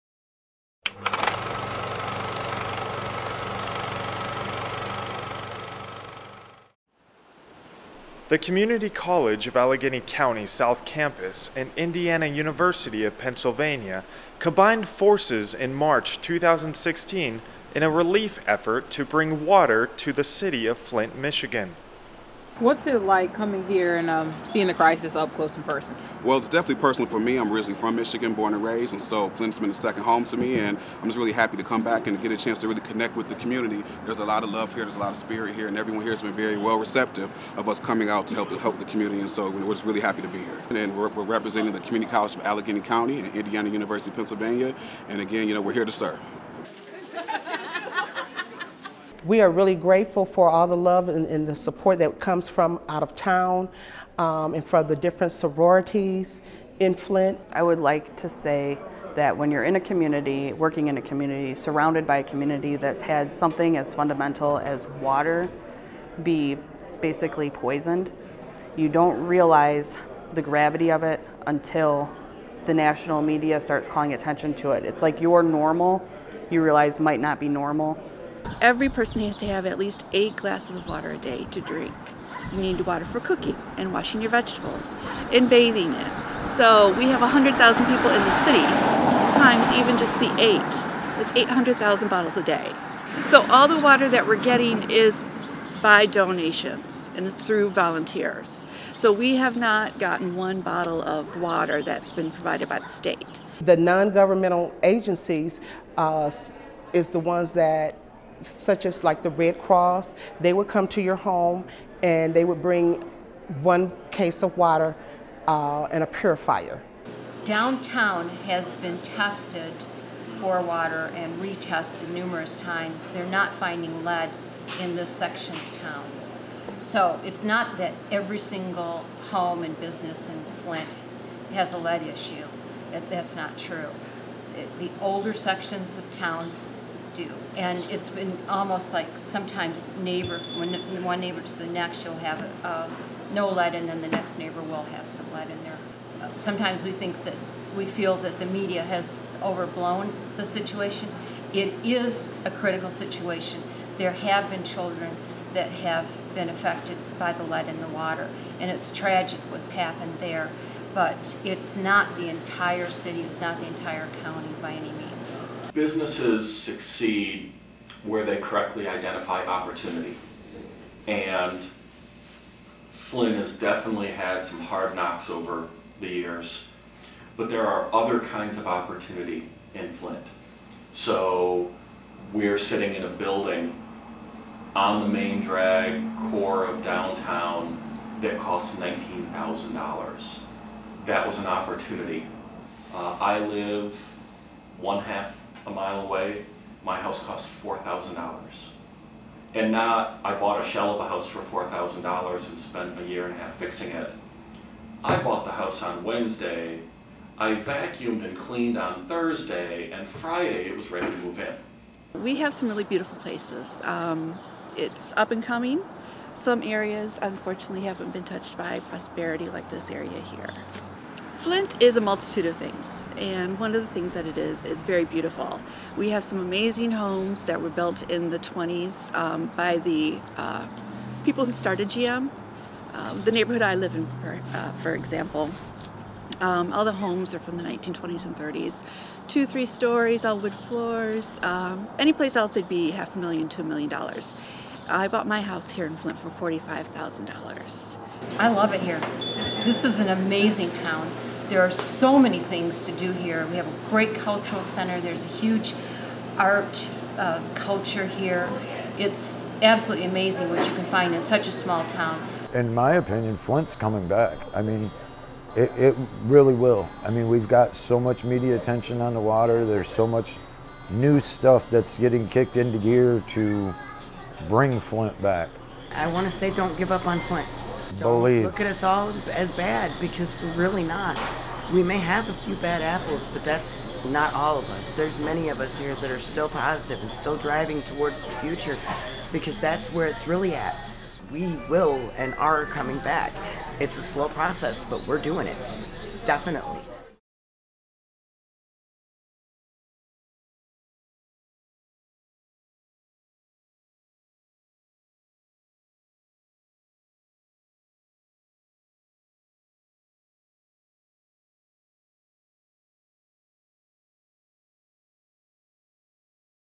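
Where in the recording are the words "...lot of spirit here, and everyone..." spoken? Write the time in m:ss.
0:34.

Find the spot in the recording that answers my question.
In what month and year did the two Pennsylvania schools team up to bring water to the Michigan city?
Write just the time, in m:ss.
0:15.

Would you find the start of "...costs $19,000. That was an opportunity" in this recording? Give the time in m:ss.
3:08.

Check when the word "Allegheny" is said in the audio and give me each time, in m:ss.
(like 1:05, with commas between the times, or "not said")
0:09, 0:42.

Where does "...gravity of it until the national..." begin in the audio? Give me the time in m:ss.
1:10.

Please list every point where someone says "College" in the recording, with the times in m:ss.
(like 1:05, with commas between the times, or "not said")
0:08, 0:42.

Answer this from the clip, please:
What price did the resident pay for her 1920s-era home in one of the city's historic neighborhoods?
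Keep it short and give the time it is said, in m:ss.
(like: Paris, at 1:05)
$45,000, at 4:06.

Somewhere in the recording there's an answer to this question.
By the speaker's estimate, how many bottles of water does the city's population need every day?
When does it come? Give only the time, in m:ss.
1:31.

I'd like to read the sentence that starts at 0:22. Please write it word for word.
What's it like coming here and um, seeing the crisis up close and personal?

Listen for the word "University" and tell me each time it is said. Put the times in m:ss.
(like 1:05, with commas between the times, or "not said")
0:12, 0:43.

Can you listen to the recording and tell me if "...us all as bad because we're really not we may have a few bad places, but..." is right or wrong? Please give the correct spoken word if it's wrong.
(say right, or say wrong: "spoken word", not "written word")
wrong: "apples", not "places".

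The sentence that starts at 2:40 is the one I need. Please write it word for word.
But it's not the entire city, it's not the entire county by any means.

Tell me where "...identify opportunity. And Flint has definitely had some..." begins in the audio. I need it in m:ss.
2:48.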